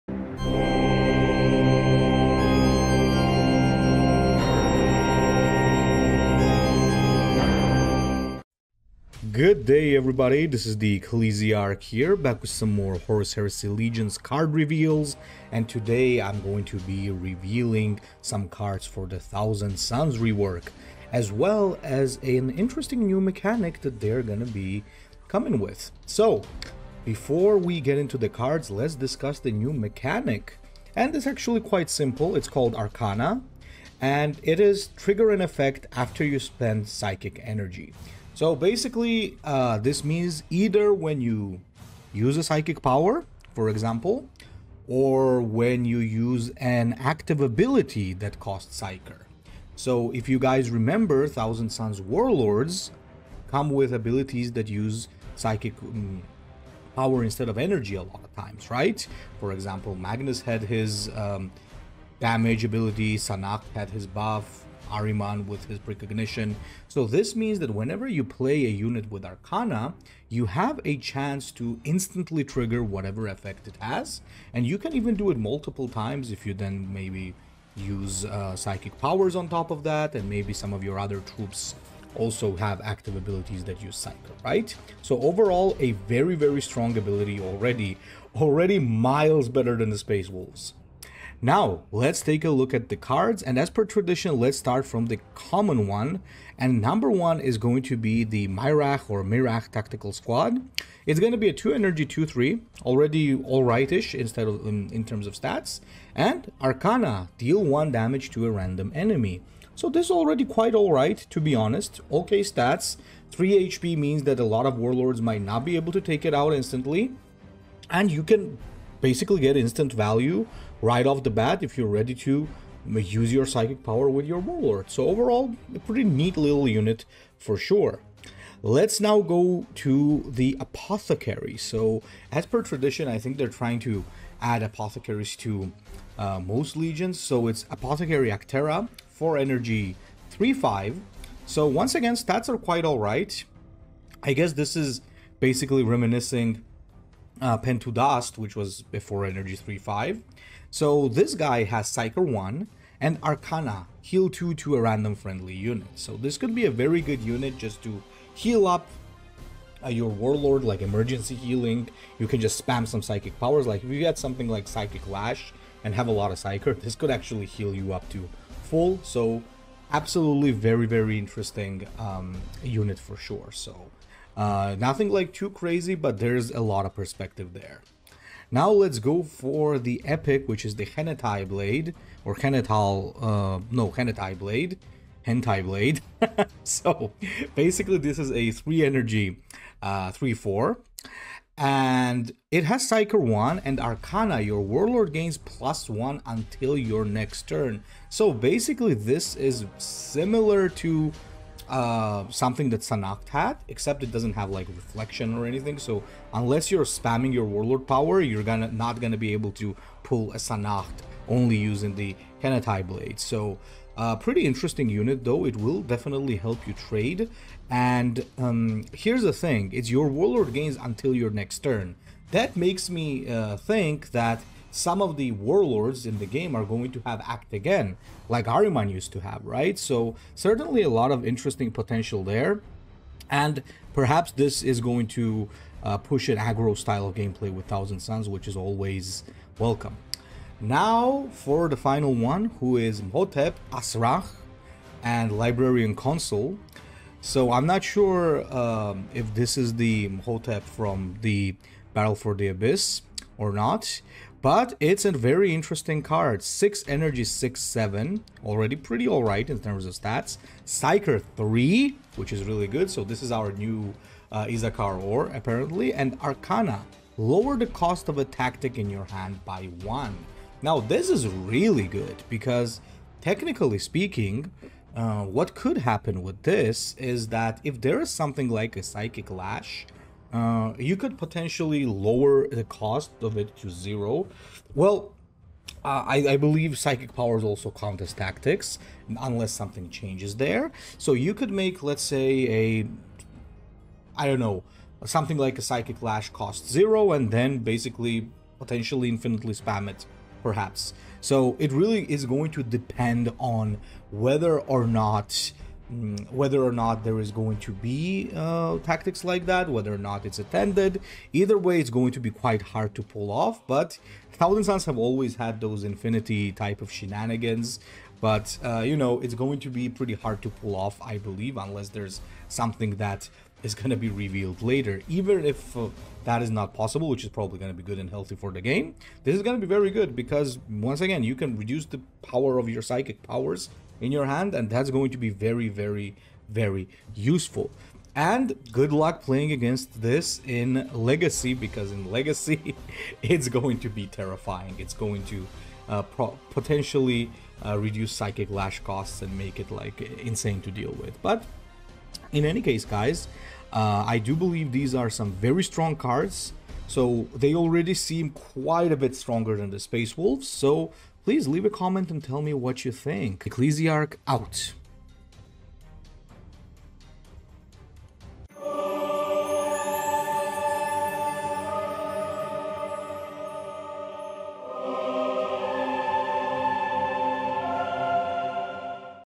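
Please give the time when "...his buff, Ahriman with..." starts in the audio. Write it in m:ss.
1:03.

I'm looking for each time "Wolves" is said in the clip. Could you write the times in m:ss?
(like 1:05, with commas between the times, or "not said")
1:30, 6:00.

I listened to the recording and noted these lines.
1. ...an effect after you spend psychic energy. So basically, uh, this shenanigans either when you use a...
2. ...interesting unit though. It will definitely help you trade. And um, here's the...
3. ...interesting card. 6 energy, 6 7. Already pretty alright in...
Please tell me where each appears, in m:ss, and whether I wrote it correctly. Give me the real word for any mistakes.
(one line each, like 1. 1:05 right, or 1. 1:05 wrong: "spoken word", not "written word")
1. 0:35 wrong: "means", not "shenanigans"
2. 3:34 right
3. 4:15 right.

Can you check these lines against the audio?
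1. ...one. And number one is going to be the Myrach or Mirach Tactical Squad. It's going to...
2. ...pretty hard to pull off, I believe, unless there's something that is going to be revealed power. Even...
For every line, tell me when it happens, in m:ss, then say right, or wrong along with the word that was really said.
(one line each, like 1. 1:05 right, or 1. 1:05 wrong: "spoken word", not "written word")
1. 1:35 right
2. 5:19 wrong: "later", not "power".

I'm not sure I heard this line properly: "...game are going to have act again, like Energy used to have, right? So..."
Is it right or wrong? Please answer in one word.
wrong.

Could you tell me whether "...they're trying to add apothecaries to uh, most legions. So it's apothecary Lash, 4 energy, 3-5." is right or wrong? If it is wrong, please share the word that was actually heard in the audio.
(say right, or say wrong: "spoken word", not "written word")
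wrong: "Actera", not "Lash".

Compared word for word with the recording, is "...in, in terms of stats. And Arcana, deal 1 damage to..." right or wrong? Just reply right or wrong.
right.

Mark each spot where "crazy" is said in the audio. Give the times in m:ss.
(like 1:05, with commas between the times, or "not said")
2:55.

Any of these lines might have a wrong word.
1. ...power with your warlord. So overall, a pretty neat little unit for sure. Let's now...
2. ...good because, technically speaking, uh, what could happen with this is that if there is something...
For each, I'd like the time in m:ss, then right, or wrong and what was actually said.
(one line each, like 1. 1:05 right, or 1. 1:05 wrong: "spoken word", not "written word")
1. 2:03 right
2. 4:31 right.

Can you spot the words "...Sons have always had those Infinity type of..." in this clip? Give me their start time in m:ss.
5:14.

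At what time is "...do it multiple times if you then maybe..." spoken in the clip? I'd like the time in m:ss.
1:15.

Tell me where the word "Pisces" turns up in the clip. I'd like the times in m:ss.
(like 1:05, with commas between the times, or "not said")
not said.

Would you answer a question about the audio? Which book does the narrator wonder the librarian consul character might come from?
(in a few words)
Battle for the Abyss.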